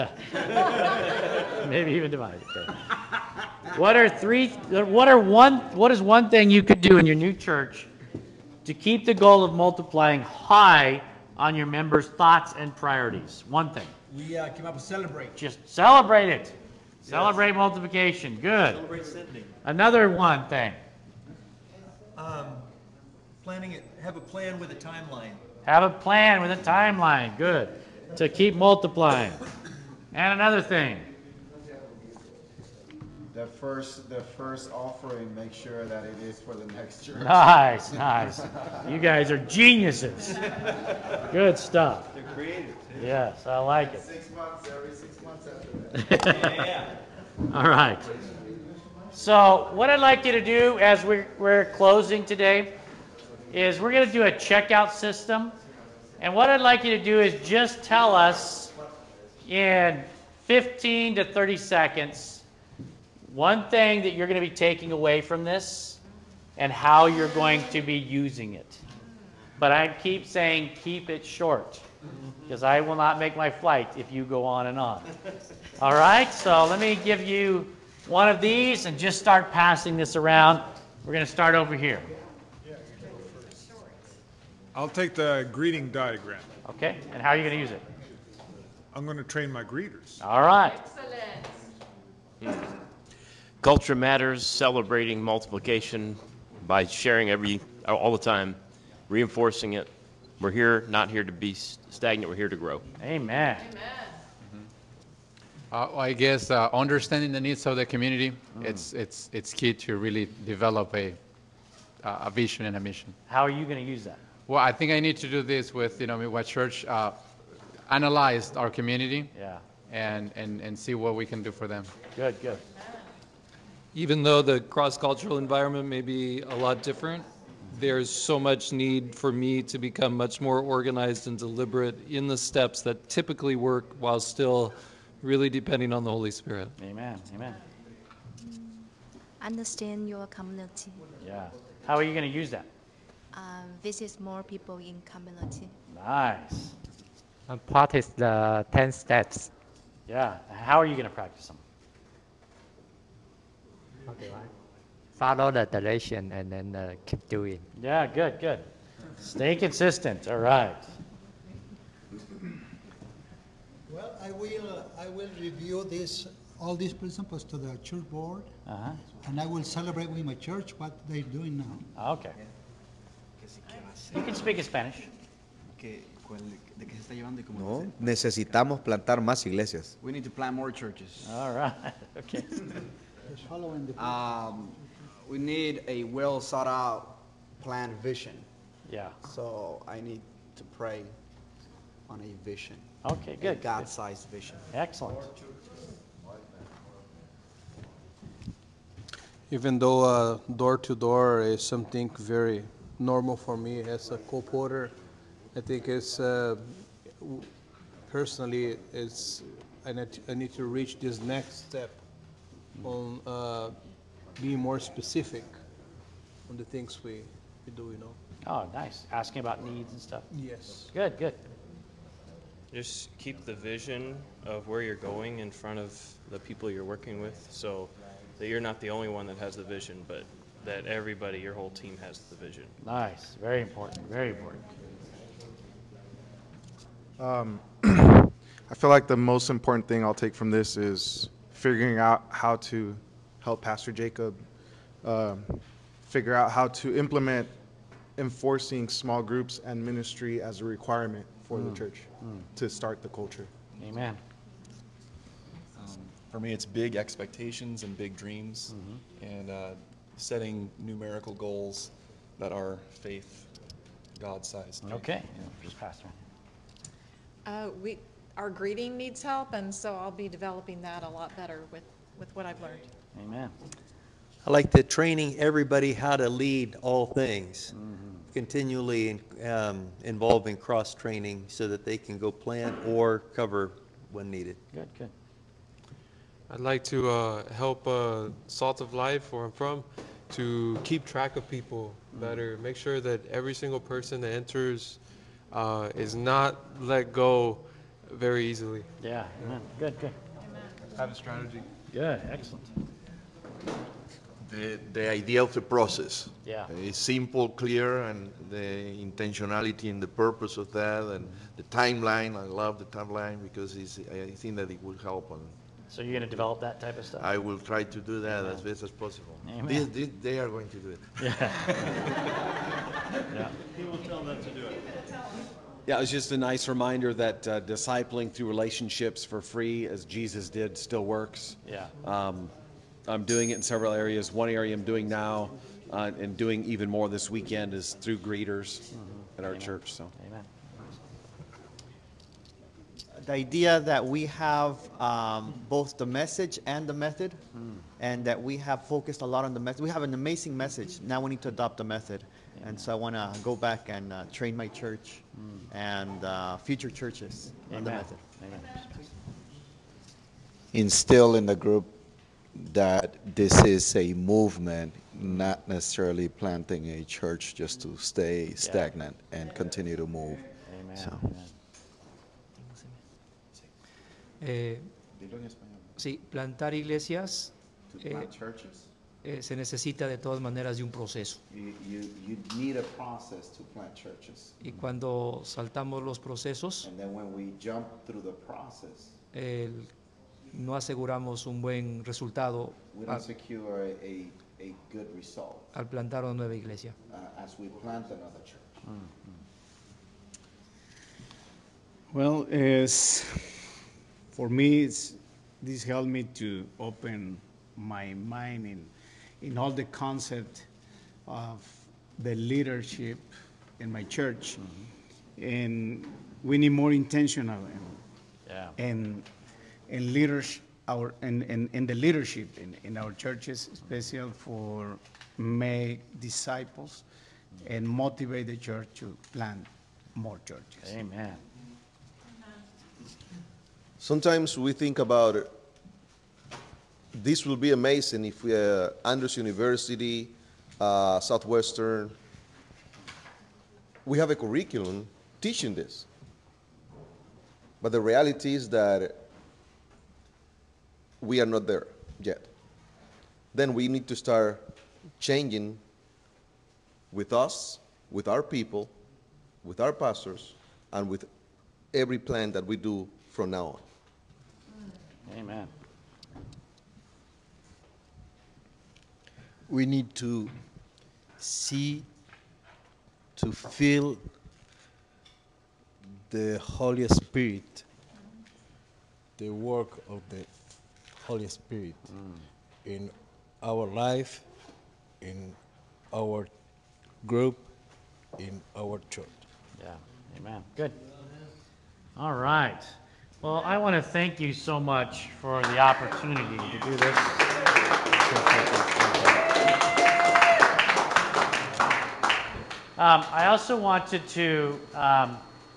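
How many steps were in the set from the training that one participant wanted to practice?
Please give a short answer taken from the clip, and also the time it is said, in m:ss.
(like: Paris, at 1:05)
10, at 2:28.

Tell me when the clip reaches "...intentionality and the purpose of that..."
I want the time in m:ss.
5:08.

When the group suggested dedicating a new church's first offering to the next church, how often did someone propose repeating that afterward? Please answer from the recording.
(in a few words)
every six months.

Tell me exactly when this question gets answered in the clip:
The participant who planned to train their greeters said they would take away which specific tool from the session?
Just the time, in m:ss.
1:25.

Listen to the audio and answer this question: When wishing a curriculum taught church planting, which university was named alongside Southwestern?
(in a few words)
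Andrews University.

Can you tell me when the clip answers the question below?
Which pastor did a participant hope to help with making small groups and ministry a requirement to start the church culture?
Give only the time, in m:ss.
4:03.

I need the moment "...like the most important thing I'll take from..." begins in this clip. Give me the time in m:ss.
3:58.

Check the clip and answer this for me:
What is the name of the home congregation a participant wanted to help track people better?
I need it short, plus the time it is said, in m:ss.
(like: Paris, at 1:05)
Salt of Life, at 4:48.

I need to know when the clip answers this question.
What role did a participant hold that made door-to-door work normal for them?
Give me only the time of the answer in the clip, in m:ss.
3:24.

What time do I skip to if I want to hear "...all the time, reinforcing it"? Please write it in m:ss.
1:37.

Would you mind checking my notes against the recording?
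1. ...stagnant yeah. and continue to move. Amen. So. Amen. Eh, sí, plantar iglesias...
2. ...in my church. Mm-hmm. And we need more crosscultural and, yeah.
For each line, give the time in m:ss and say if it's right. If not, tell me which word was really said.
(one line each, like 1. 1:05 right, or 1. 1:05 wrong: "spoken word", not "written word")
1. 6:08 right
2. 6:53 wrong: "intentional", not "crosscultural".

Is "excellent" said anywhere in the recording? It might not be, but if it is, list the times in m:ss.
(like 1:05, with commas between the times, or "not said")
1:30, 3:14, 5:02.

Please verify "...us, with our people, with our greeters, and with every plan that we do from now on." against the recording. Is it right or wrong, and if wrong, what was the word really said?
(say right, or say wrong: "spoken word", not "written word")
wrong: "pastors", not "greeters".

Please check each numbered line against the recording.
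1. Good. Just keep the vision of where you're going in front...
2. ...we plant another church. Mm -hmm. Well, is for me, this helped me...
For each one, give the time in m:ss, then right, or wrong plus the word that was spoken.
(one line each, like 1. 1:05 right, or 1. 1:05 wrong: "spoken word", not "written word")
1. 3:41 right
2. 6:37 right.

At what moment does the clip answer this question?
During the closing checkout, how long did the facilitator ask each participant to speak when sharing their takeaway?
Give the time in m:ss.
1:00.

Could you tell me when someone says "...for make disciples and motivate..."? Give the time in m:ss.
7:04.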